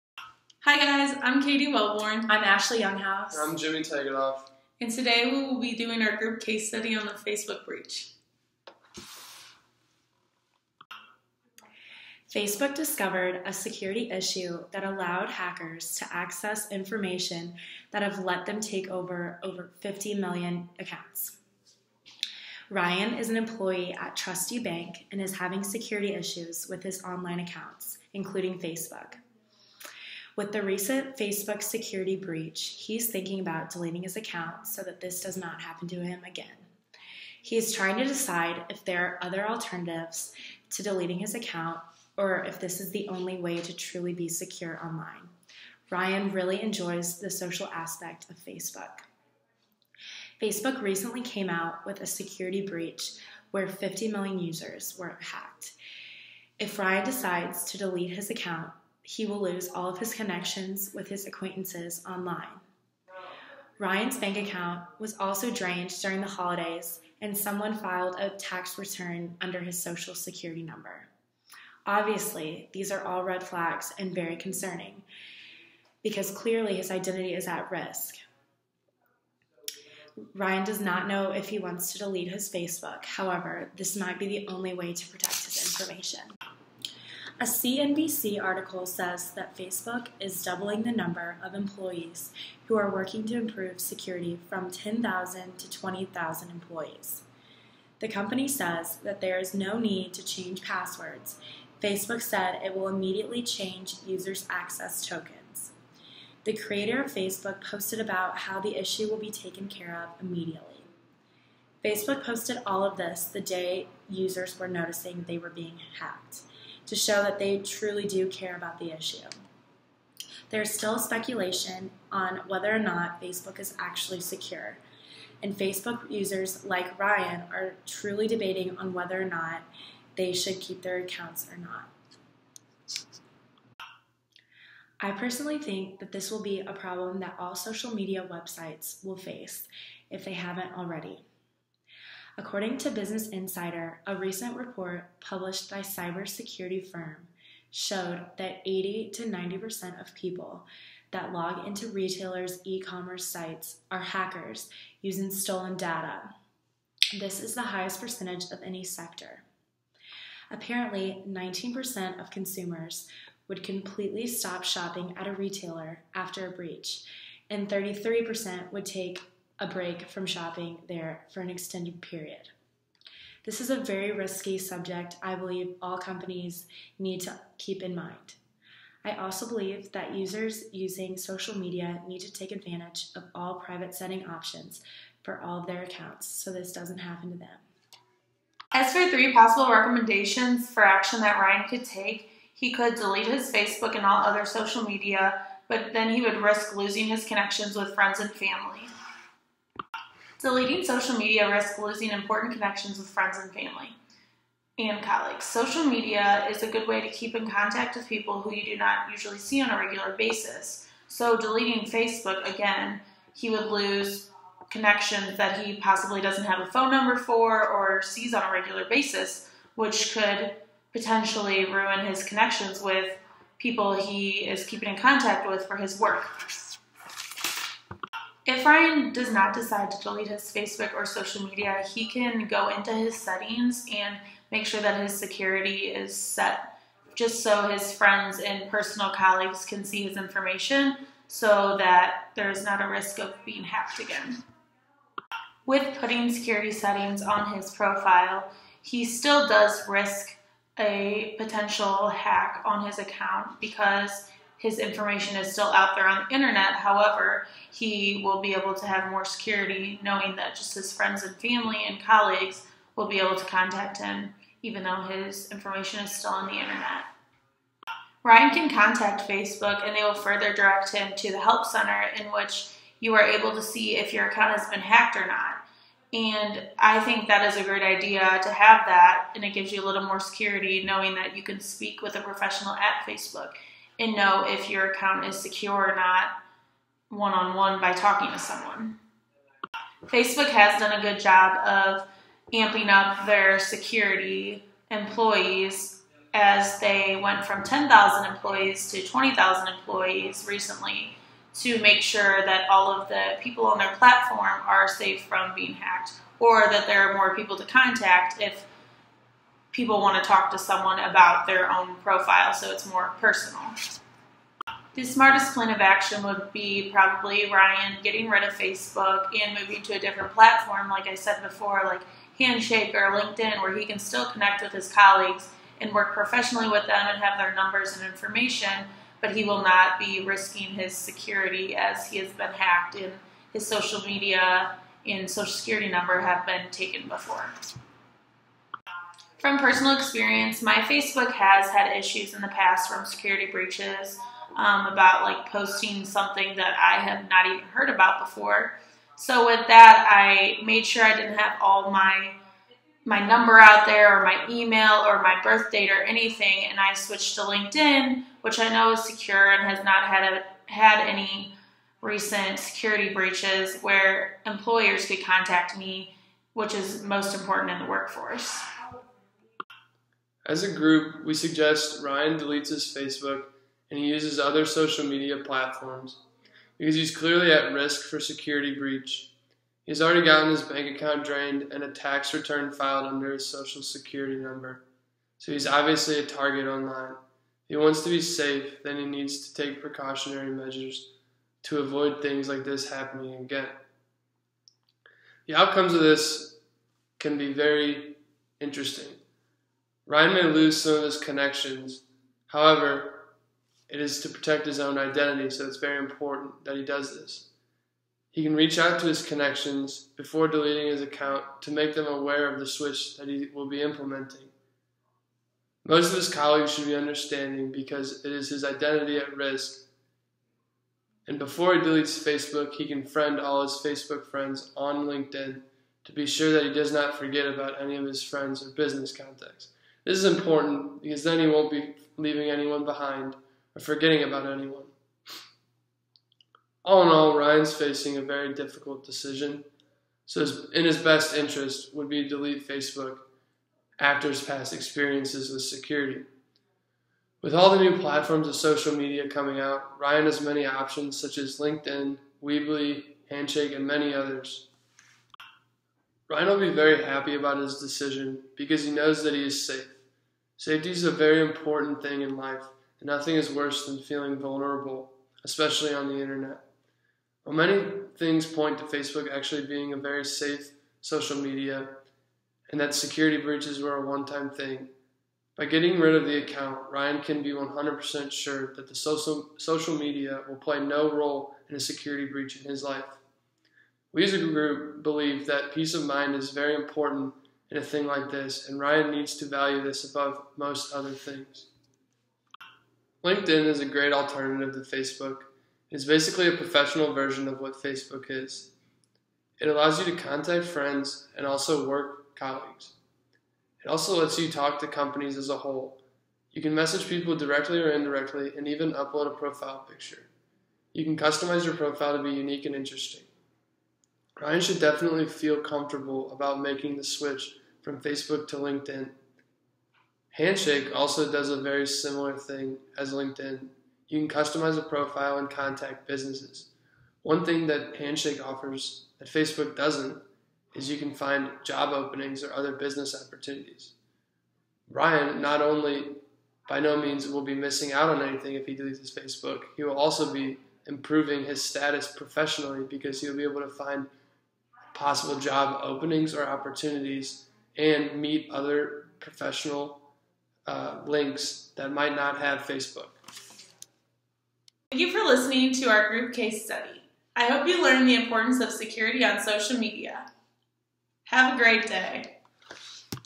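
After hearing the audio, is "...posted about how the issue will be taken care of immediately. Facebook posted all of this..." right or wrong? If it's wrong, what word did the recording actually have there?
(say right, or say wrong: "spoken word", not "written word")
right.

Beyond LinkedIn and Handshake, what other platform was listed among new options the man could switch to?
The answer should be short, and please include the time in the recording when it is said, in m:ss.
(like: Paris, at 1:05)
Weebly, at 7:32.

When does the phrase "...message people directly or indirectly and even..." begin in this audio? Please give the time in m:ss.
8:26.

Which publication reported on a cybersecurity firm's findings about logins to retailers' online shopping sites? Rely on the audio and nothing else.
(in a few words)
Business Insider.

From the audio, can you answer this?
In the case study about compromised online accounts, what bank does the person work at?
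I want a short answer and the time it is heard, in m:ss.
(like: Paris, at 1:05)
Trusty Bank, at 0:24.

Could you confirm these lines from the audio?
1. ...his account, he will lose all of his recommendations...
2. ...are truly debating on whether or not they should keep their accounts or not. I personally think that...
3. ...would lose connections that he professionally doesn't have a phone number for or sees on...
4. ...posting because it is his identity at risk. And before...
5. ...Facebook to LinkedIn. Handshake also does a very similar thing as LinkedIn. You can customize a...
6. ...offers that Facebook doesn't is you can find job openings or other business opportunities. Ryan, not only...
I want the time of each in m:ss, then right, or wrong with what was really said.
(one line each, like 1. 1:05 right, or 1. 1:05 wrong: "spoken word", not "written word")
1. 0:58 wrong: "connections", not "recommendations"
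2. 2:07 right
3. 3:33 wrong: "possibly", not "professionally"
4. 6:56 wrong: "understanding", not "posting"
5. 8:37 right
6. 8:48 right.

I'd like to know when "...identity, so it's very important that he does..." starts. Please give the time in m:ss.
6:44.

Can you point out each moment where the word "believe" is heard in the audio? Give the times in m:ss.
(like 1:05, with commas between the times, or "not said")
2:55, 2:59, 8:05.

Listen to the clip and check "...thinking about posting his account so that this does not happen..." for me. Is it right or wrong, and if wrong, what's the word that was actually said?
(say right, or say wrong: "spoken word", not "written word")
wrong: "deleting", not "posting".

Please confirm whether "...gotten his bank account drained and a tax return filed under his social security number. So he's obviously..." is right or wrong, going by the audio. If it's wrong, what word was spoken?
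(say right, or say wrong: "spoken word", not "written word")
right.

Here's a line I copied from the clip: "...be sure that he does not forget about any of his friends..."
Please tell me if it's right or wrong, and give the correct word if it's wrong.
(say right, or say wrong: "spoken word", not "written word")
right.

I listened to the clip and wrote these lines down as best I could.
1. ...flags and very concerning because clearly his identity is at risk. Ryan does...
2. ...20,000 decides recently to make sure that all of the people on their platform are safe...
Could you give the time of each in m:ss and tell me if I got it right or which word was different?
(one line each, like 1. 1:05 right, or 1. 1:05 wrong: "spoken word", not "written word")
1. 1:13 right
2. 4:59 wrong: "employees", not "decides".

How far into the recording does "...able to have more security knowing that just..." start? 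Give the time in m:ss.
4:18.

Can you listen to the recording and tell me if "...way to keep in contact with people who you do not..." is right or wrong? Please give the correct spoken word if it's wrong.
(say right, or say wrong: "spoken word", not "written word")
right.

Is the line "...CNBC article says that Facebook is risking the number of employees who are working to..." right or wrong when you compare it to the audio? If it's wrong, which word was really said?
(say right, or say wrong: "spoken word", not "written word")
wrong: "doubling", not "risking".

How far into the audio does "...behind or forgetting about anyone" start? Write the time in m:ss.
7:12.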